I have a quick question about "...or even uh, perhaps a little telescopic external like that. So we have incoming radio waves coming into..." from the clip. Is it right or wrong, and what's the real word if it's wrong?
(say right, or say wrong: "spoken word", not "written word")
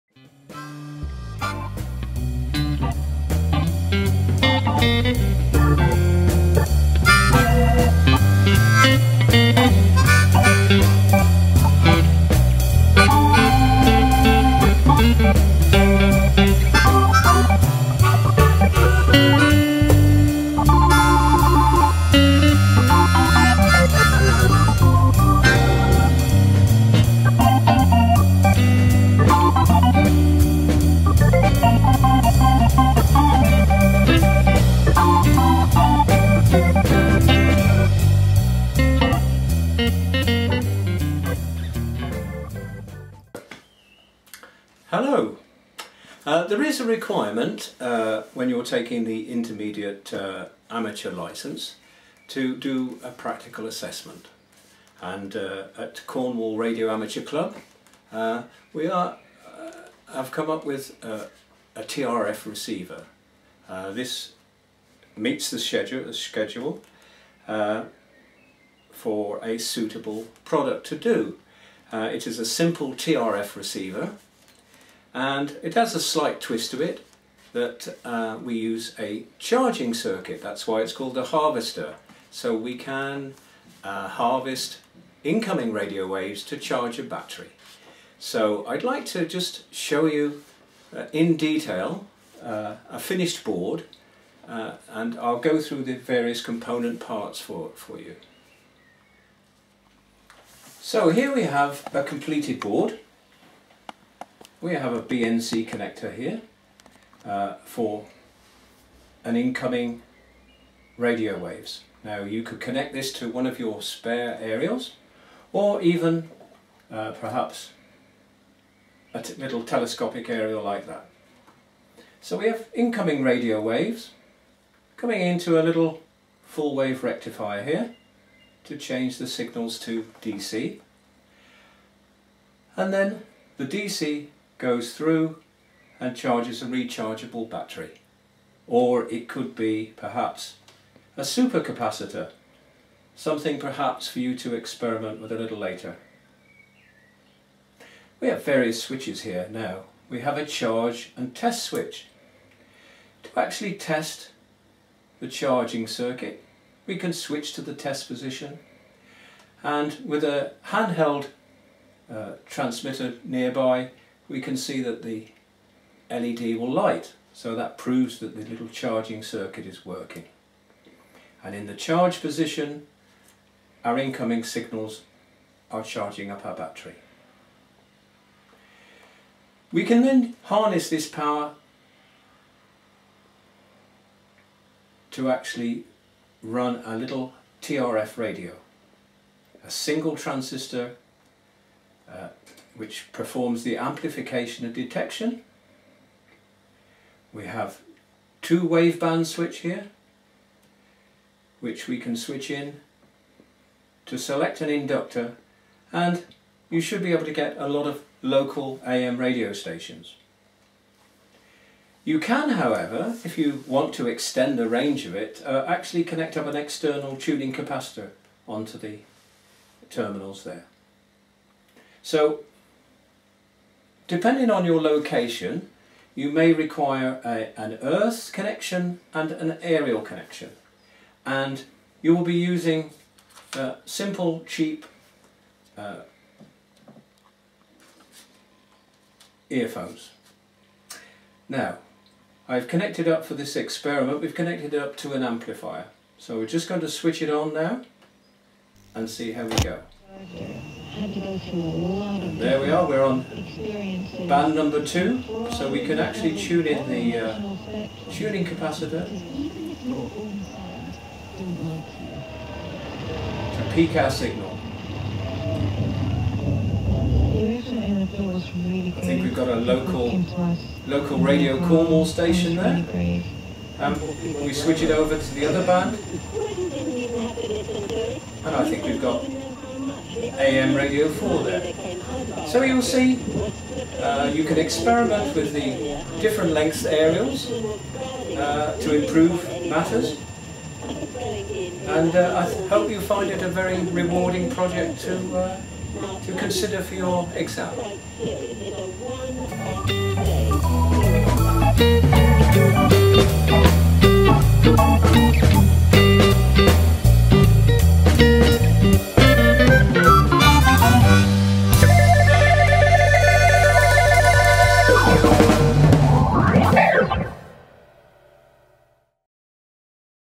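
wrong: "aerial", not "external".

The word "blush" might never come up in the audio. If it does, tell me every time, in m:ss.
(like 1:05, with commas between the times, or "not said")
not said.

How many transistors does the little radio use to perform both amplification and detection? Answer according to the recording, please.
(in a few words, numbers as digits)
1.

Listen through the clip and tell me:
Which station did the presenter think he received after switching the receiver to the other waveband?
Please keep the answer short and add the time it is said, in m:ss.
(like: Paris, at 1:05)
AM Radio 4, at 4:40.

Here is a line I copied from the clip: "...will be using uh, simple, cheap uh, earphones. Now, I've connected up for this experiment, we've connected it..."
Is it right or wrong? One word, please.
right.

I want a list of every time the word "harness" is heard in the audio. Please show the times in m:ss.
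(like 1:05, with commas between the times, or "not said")
3:00.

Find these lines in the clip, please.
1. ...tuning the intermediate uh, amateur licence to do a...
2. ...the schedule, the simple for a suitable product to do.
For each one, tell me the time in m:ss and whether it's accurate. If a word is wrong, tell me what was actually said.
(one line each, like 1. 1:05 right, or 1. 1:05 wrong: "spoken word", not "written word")
1. 0:48 wrong: "taking", not "tuning"
2. 1:05 wrong: "schedule", not "simple".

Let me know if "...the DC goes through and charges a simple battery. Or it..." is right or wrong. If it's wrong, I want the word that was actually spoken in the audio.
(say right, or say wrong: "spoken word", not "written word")
wrong: "rechargeable", not "simple".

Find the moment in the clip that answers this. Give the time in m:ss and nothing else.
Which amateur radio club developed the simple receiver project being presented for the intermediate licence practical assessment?
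0:56.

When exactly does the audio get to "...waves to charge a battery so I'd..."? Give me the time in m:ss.
1:26.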